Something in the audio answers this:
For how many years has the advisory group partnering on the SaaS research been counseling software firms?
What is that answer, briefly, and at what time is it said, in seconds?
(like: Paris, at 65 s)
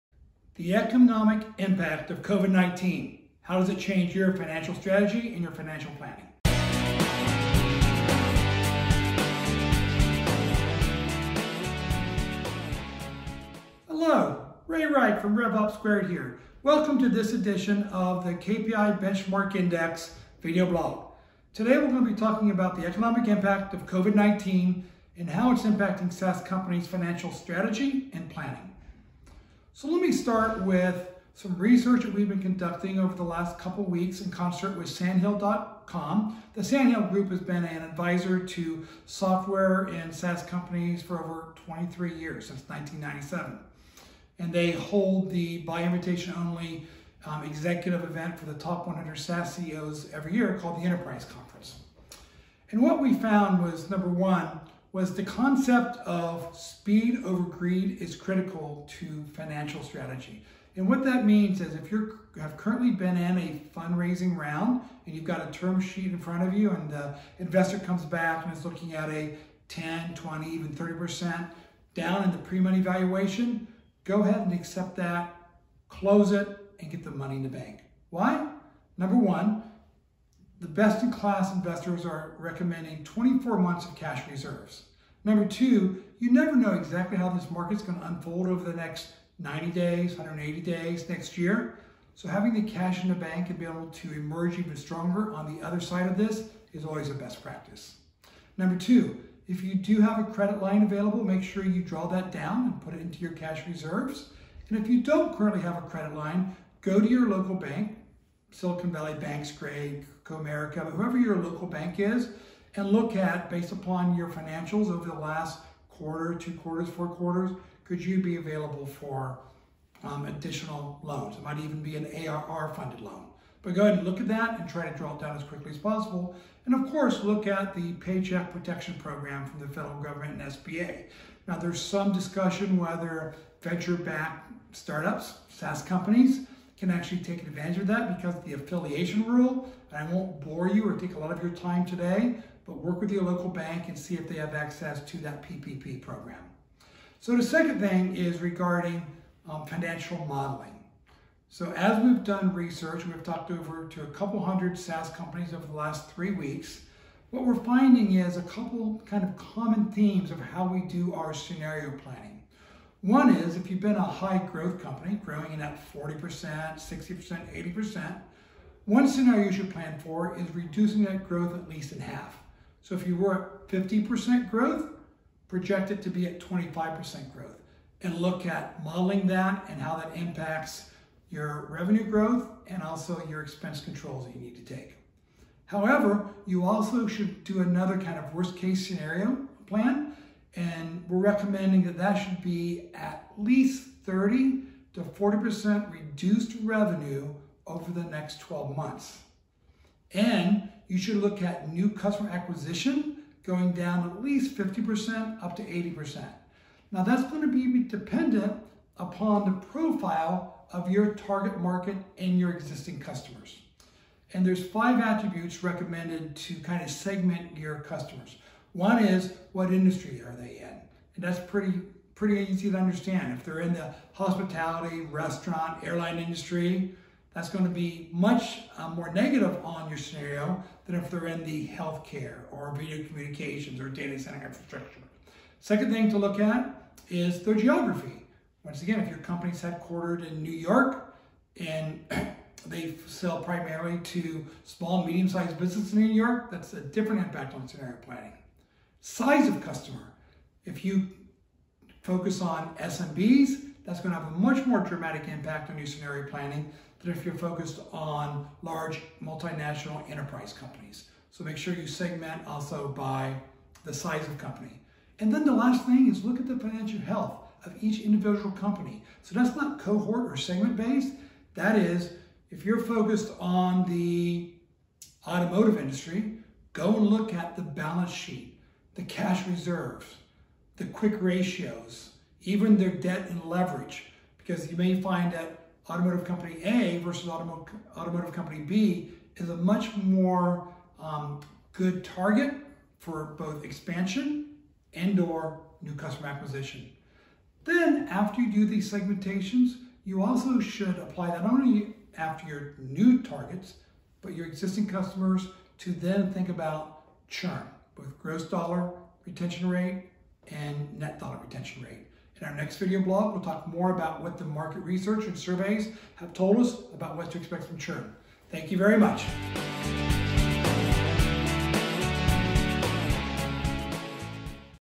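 23 years, at 41 s.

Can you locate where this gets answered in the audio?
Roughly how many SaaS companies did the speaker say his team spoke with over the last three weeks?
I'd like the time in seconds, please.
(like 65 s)
154 s.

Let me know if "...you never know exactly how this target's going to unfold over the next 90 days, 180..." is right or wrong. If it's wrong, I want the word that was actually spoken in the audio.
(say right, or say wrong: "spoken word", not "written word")
wrong: "market", not "target".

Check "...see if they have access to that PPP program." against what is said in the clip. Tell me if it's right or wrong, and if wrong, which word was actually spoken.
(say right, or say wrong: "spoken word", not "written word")
right.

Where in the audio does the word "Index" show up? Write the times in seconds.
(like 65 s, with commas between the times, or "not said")
19 s.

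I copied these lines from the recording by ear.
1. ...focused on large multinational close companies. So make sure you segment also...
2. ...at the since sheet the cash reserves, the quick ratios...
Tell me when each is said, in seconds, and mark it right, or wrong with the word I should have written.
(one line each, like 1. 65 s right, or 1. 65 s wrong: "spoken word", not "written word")
1. 257 s wrong: "enterprise", not "close"
2. 277 s wrong: "balance", not "since".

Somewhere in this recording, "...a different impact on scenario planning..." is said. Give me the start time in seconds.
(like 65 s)
246 s.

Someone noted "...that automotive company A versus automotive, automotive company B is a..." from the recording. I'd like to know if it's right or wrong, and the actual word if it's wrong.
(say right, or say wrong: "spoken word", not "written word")
right.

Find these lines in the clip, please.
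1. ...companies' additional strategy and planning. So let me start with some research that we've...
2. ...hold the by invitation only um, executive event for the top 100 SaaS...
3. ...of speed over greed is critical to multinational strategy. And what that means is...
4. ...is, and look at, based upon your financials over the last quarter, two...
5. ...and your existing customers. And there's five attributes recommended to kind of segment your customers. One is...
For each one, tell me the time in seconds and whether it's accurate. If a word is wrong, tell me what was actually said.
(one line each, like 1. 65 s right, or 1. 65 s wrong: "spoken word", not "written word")
1. 26 s wrong: "financial", not "additional"
2. 44 s right
3. 56 s wrong: "financial", not "multinational"
4. 111 s right
5. 212 s right.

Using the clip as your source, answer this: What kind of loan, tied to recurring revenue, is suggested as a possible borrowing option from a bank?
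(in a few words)
ARR funded loan.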